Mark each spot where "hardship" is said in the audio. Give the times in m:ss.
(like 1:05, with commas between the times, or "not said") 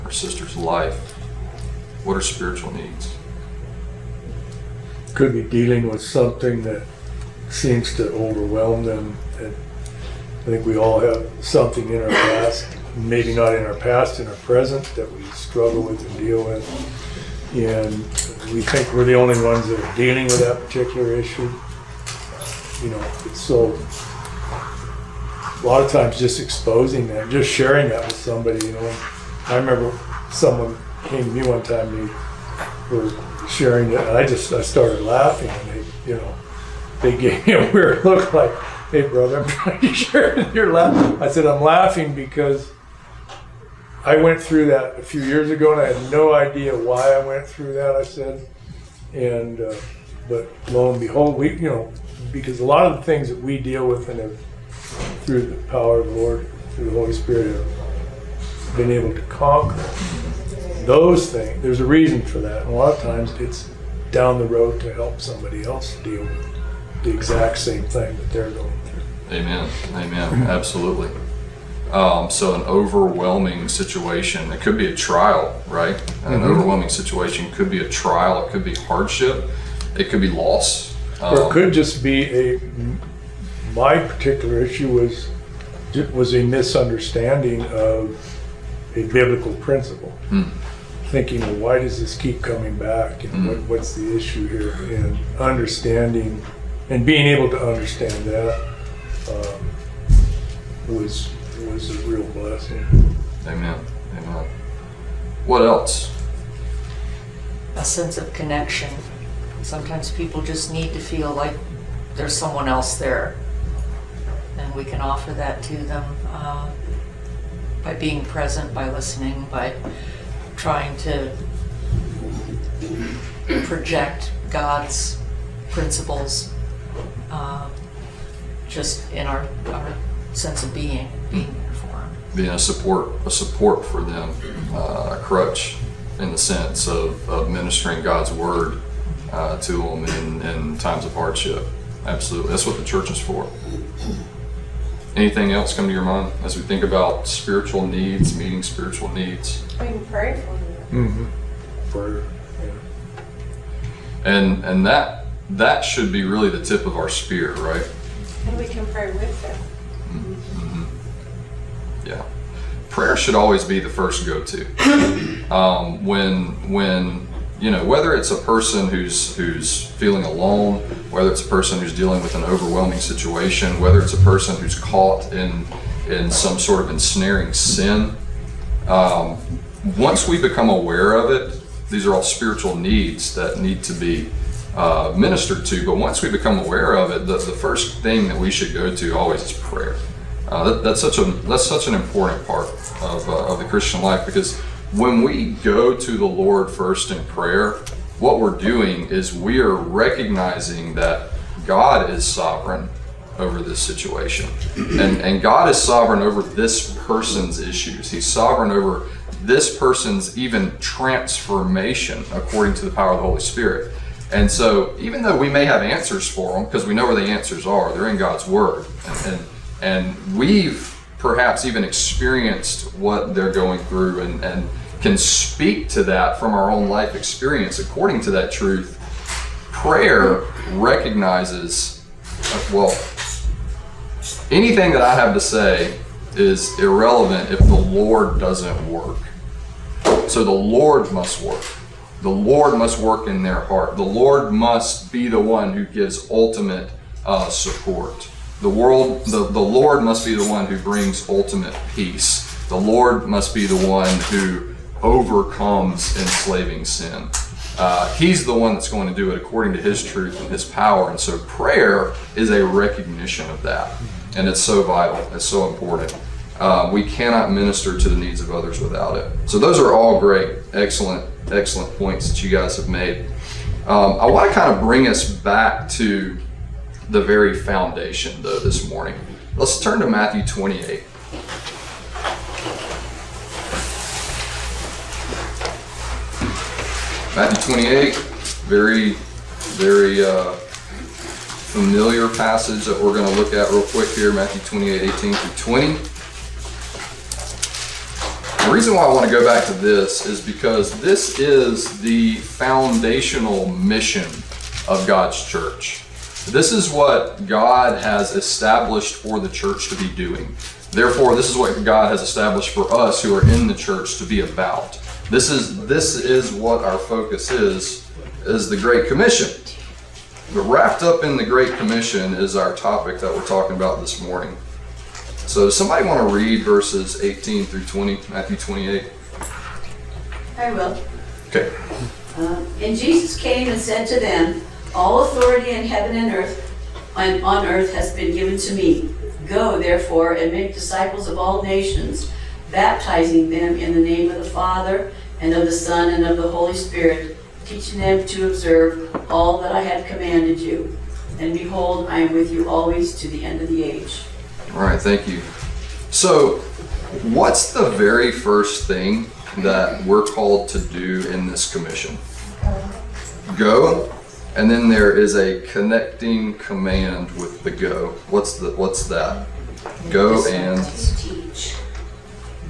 1:18, 2:21.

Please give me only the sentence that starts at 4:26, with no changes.
Uh, we cannot minister to the needs of others without it.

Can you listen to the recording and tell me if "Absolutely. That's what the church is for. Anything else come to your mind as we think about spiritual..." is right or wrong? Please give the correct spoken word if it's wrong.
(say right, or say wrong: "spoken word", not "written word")
right.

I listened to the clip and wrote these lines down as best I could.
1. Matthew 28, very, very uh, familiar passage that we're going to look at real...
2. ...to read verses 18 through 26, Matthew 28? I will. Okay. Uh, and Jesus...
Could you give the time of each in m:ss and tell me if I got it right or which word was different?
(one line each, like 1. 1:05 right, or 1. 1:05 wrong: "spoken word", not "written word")
1. 4:47 right
2. 5:26 wrong: "20", not "26".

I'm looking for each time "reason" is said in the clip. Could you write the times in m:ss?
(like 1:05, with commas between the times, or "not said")
1:01, 4:58.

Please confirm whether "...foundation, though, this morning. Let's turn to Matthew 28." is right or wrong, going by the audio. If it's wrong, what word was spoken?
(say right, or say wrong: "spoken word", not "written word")
right.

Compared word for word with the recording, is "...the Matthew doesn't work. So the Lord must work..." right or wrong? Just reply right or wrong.
wrong.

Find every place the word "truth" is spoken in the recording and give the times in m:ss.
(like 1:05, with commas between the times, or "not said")
3:48, 4:20.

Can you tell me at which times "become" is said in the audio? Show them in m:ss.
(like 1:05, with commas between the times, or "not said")
3:00, 3:06.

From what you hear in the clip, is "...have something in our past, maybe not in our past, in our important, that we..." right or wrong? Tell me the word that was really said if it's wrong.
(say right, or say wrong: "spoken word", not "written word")
wrong: "present", not "important".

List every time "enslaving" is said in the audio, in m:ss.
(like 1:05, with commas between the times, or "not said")
4:16.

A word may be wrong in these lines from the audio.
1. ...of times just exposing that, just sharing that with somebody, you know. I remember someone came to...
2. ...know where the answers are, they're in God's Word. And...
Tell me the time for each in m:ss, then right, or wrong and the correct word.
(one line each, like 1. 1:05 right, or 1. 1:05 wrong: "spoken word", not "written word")
1. 0:25 right
2. 3:36 right.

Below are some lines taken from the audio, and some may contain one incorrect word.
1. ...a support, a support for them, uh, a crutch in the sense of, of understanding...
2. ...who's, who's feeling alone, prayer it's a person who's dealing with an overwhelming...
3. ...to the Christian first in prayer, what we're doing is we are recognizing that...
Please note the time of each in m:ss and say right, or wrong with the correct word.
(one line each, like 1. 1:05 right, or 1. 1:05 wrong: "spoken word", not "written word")
1. 2:12 wrong: "ministering", not "understanding"
2. 2:48 wrong: "whether", not "prayer"
3. 3:15 wrong: "Lord", not "Christian".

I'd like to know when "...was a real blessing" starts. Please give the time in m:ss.
1:41.